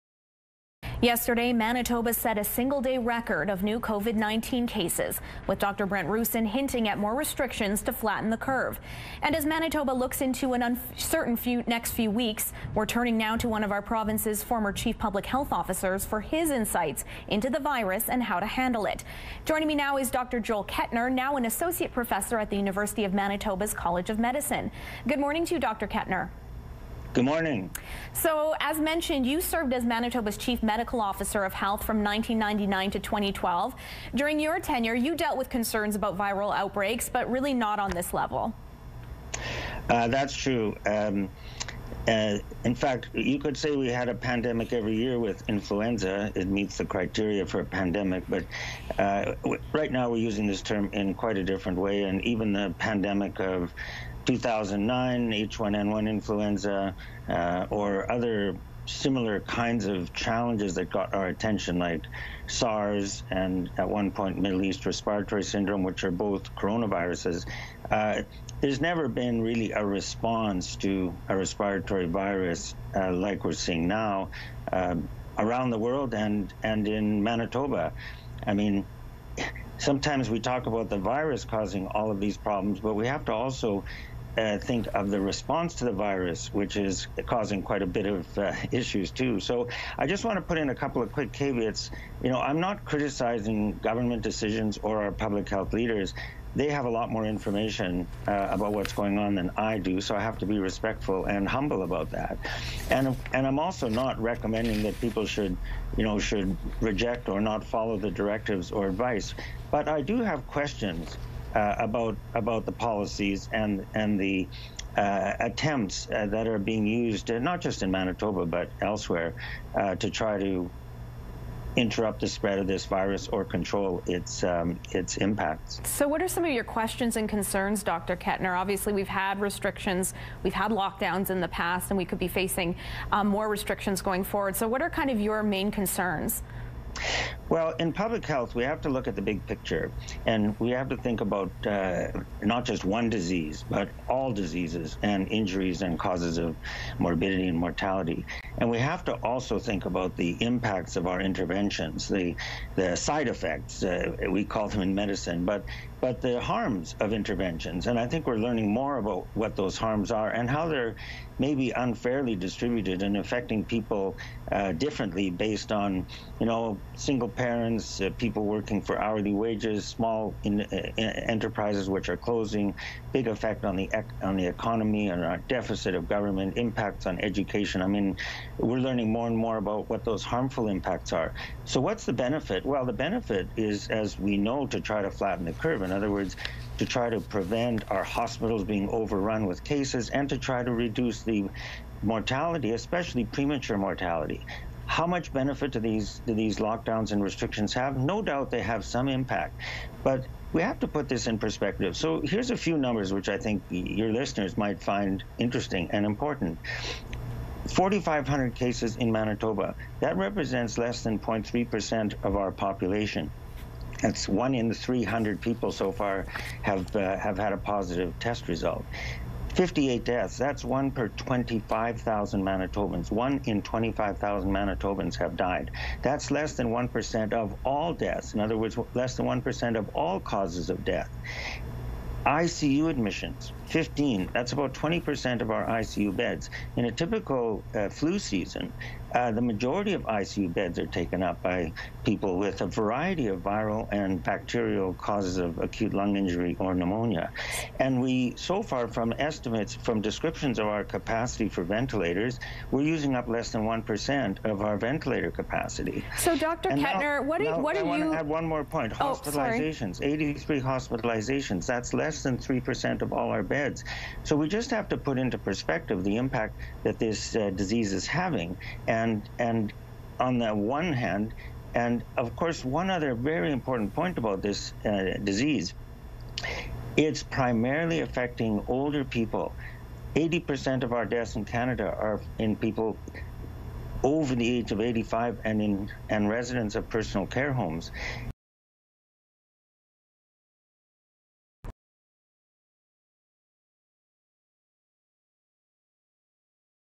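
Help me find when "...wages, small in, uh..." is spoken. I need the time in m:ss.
2:49.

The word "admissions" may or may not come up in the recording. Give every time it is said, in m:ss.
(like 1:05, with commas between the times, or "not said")
3:52.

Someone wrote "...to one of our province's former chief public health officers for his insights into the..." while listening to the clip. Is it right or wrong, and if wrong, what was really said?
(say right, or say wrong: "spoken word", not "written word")
right.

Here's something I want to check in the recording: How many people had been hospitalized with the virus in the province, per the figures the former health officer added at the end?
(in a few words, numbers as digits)
83.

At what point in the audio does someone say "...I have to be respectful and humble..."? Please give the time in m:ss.
1:40.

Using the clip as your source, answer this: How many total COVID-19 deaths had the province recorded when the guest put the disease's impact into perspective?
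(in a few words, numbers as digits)
58.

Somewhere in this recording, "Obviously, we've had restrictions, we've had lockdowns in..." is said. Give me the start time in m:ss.
2:08.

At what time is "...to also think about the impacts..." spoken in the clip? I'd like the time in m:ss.
2:29.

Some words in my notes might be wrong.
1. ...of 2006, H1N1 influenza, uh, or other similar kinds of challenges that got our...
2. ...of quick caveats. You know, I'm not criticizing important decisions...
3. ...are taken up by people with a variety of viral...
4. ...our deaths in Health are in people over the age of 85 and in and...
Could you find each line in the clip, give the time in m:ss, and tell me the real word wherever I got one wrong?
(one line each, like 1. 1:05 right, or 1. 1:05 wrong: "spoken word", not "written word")
1. 0:53 wrong: "2009", not "2006"
2. 1:31 wrong: "government", not "important"
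3. 4:00 right
4. 4:40 wrong: "Canada", not "Health".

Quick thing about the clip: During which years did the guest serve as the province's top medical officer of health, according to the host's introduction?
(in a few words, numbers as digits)
1999 to 2012.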